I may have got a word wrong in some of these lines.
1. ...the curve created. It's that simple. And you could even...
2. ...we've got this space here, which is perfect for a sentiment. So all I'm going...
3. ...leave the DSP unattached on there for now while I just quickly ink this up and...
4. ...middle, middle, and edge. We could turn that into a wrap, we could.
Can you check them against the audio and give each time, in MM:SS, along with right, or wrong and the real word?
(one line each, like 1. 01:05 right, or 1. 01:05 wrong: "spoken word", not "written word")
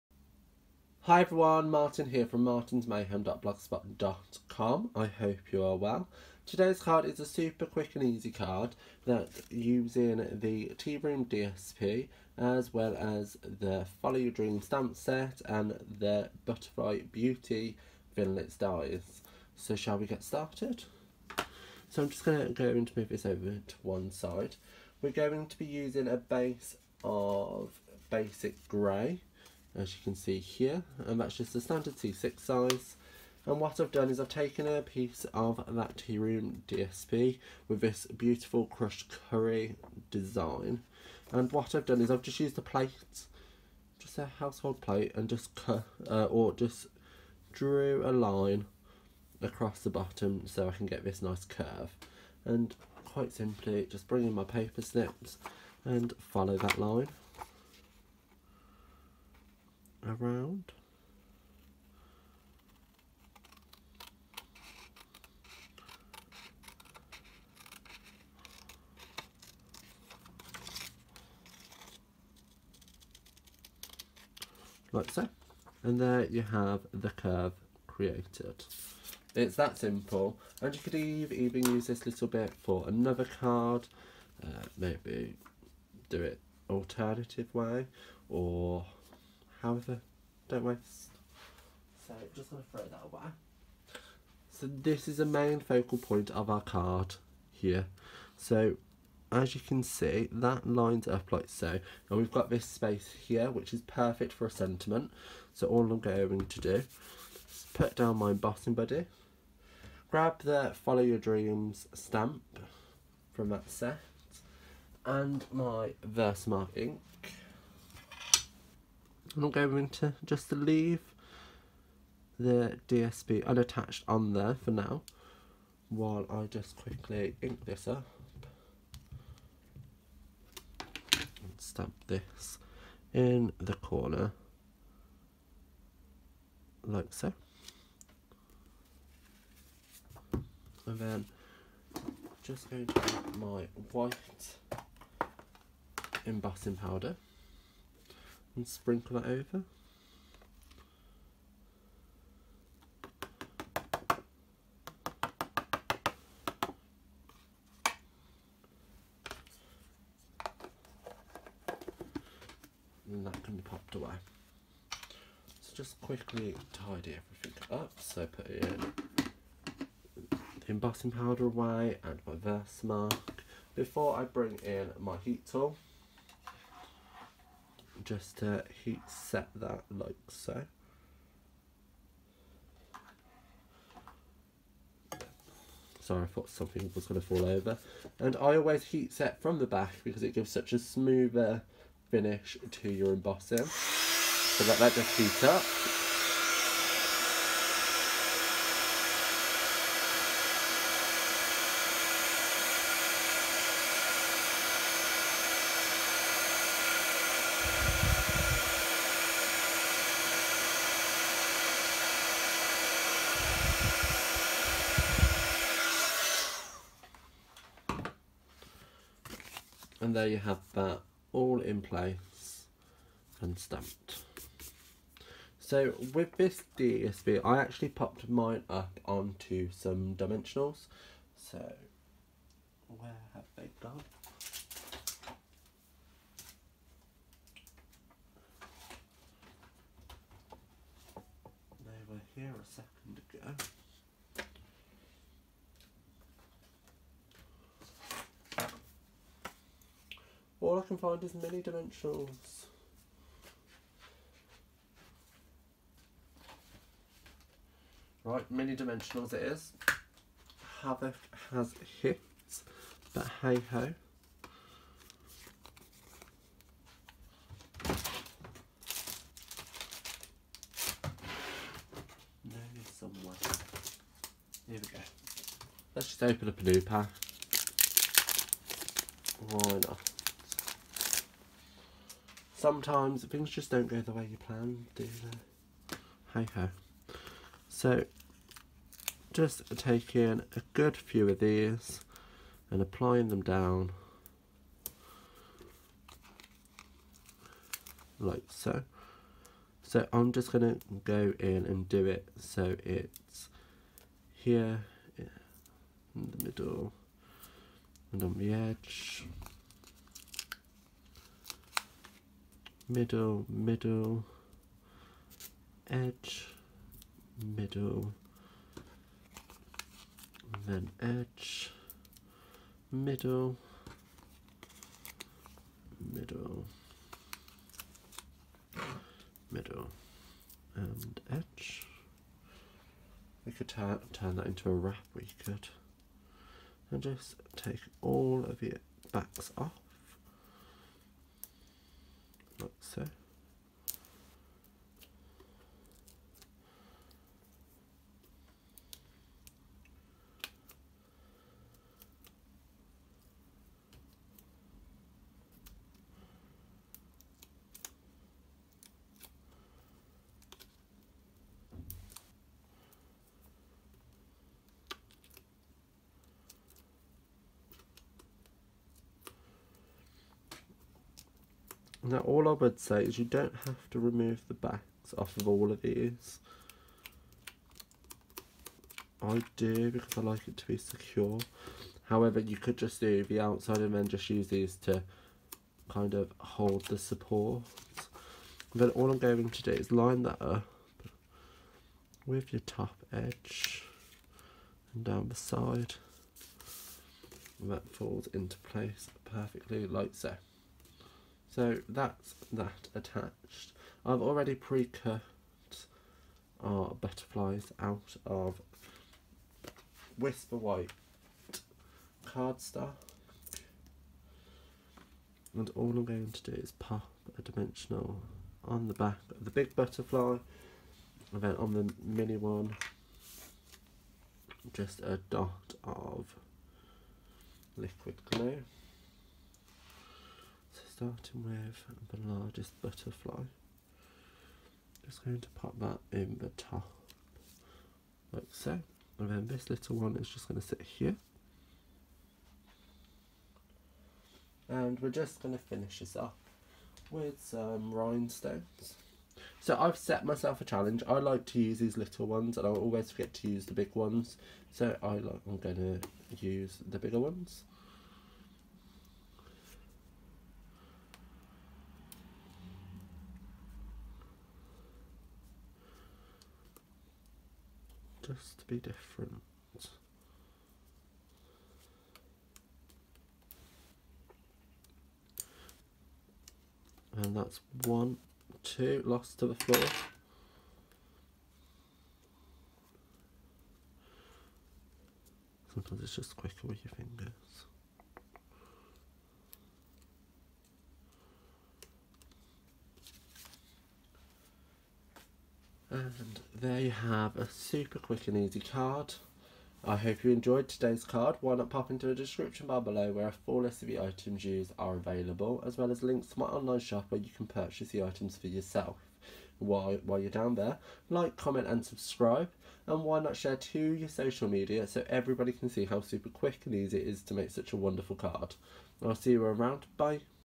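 1. 01:16 right
2. 01:42 right
3. 02:00 right
4. 05:26 right.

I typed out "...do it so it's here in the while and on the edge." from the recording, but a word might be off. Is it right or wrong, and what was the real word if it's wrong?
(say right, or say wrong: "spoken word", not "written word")
wrong: "middle", not "while".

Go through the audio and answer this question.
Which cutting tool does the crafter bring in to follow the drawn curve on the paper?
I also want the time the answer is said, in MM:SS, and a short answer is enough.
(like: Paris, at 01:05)
Paper snips, at 00:54.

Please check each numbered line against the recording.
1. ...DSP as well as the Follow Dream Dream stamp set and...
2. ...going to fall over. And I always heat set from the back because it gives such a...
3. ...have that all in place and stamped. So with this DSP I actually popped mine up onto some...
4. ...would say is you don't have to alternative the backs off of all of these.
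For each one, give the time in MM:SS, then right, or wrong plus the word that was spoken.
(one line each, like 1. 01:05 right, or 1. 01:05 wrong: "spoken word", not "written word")
1. 00:11 wrong: "Your", not "Dream"
2. 03:07 right
3. 03:40 right
4. 06:12 wrong: "remove", not "alternative".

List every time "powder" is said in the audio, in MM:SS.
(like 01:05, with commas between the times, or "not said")
02:26, 02:51.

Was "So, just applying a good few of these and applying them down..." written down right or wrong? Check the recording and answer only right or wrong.
wrong.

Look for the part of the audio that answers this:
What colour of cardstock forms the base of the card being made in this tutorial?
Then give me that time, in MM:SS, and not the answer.
00:28.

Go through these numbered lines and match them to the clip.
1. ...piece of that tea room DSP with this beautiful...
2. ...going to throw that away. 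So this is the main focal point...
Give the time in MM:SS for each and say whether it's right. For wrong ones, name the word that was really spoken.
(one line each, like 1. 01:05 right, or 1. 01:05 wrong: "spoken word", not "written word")
1. 00:34 right
2. 01:32 right.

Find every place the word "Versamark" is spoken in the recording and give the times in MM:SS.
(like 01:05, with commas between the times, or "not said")
01:56, 02:52.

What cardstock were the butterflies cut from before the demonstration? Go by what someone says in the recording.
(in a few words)
Whisper White.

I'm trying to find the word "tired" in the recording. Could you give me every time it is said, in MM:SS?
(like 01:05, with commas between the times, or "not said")
not said.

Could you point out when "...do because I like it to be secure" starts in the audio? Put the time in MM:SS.
06:19.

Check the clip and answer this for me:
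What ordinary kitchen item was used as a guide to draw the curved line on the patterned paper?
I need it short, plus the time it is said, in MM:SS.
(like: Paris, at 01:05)
A household plate, at 00:44.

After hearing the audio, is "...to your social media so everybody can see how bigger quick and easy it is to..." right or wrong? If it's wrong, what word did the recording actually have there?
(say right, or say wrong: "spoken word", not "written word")
wrong: "super", not "bigger".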